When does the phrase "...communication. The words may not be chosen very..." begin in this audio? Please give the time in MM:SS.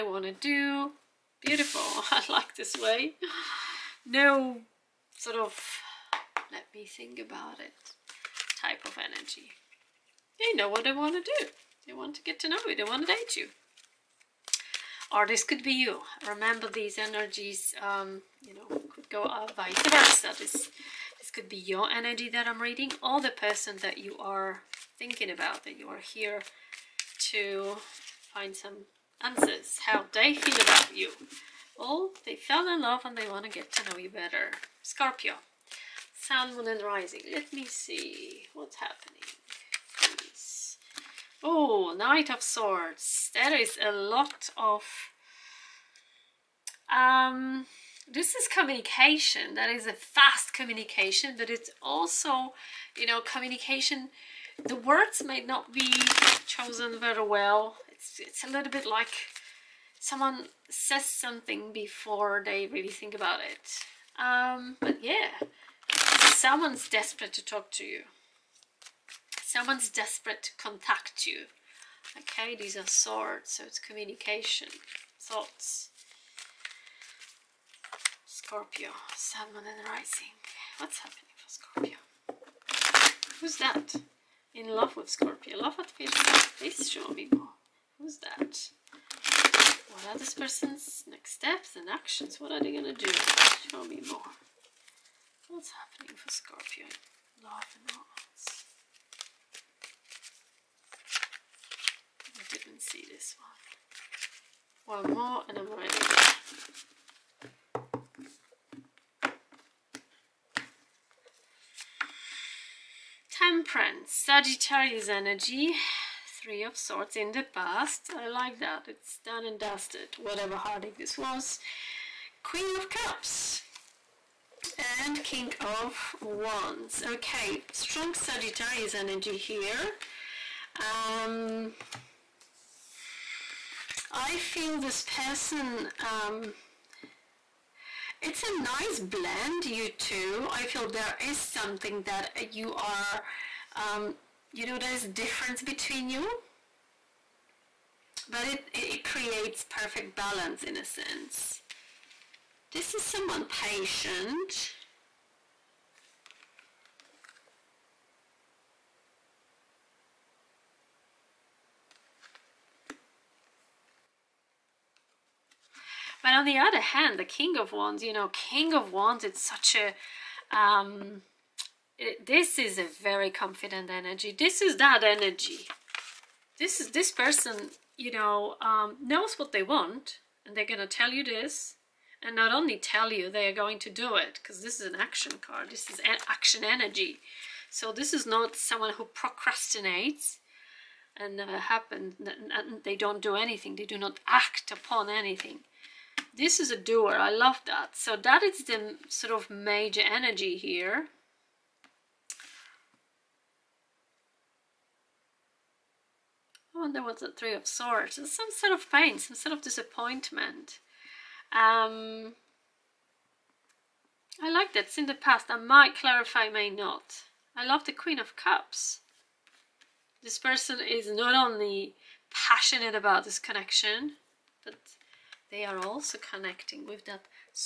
00:53.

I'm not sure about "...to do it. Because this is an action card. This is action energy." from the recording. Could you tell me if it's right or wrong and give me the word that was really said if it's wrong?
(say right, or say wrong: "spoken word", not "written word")
right.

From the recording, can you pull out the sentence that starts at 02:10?
Um, I feel this person, um, it's a nice blend, you two.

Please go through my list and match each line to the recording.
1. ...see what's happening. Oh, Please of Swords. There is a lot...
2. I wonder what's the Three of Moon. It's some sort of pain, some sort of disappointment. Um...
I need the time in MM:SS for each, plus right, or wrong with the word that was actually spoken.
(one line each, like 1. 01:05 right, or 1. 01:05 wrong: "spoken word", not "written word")
1. 00:37 wrong: "Knight", not "Please"
2. 03:26 wrong: "Swords", not "Moon".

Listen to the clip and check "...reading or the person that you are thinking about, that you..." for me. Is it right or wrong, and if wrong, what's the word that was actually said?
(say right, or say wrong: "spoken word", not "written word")
right.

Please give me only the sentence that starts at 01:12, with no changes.
Okay, these are swords, so it's communication, thoughts.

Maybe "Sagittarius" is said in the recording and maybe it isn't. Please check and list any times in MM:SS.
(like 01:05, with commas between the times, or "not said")
01:54, 02:08.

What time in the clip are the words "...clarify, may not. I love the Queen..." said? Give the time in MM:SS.
03:35.